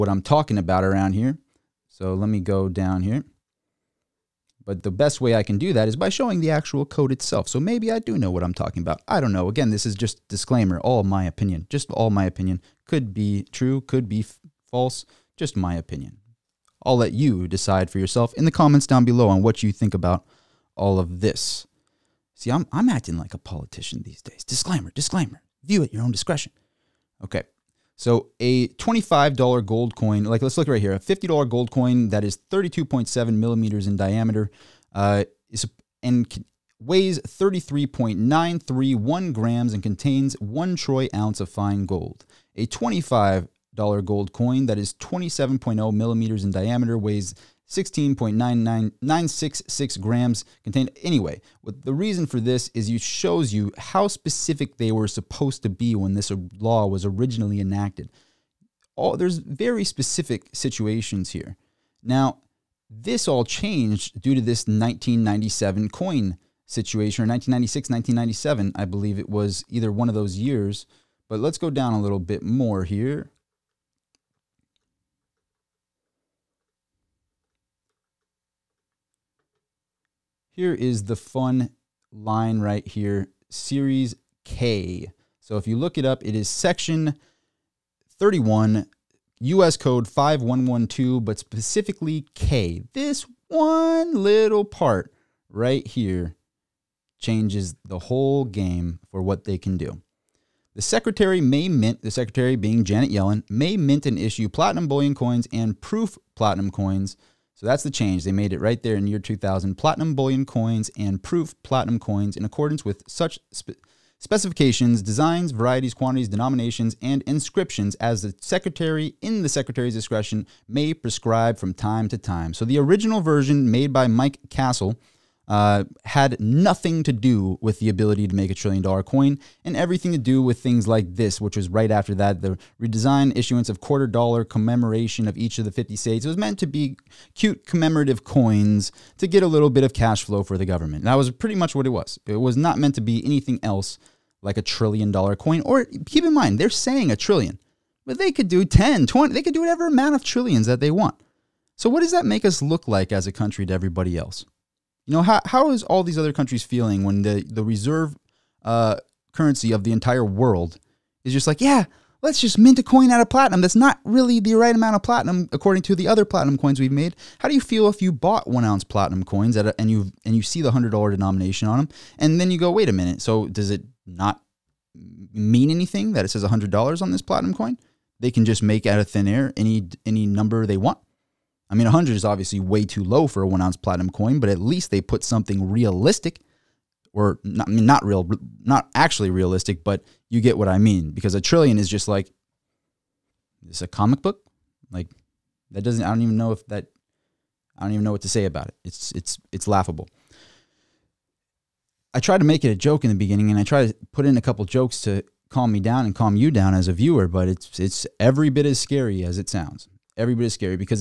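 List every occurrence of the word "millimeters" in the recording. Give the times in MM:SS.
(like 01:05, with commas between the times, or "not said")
00:33, 00:45.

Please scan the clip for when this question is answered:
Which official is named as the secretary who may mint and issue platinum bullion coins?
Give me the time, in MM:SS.
01:42.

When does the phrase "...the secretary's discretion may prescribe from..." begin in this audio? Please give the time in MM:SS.
01:59.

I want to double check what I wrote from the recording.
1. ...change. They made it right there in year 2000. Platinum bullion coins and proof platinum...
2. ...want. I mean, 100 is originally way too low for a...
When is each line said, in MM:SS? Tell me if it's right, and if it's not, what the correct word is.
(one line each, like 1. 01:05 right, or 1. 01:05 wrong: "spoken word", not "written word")
1. 01:47 right
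2. 03:00 wrong: "obviously", not "originally".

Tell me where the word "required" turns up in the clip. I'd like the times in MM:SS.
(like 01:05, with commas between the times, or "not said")
not said.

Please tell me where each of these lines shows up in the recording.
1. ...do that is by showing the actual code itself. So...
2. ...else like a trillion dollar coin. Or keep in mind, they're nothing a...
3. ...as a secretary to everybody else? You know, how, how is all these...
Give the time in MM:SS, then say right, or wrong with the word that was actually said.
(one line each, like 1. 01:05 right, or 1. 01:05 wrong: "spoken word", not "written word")
1. 00:05 right
2. 02:23 wrong: "saying", not "nothing"
3. 02:33 wrong: "country", not "secretary".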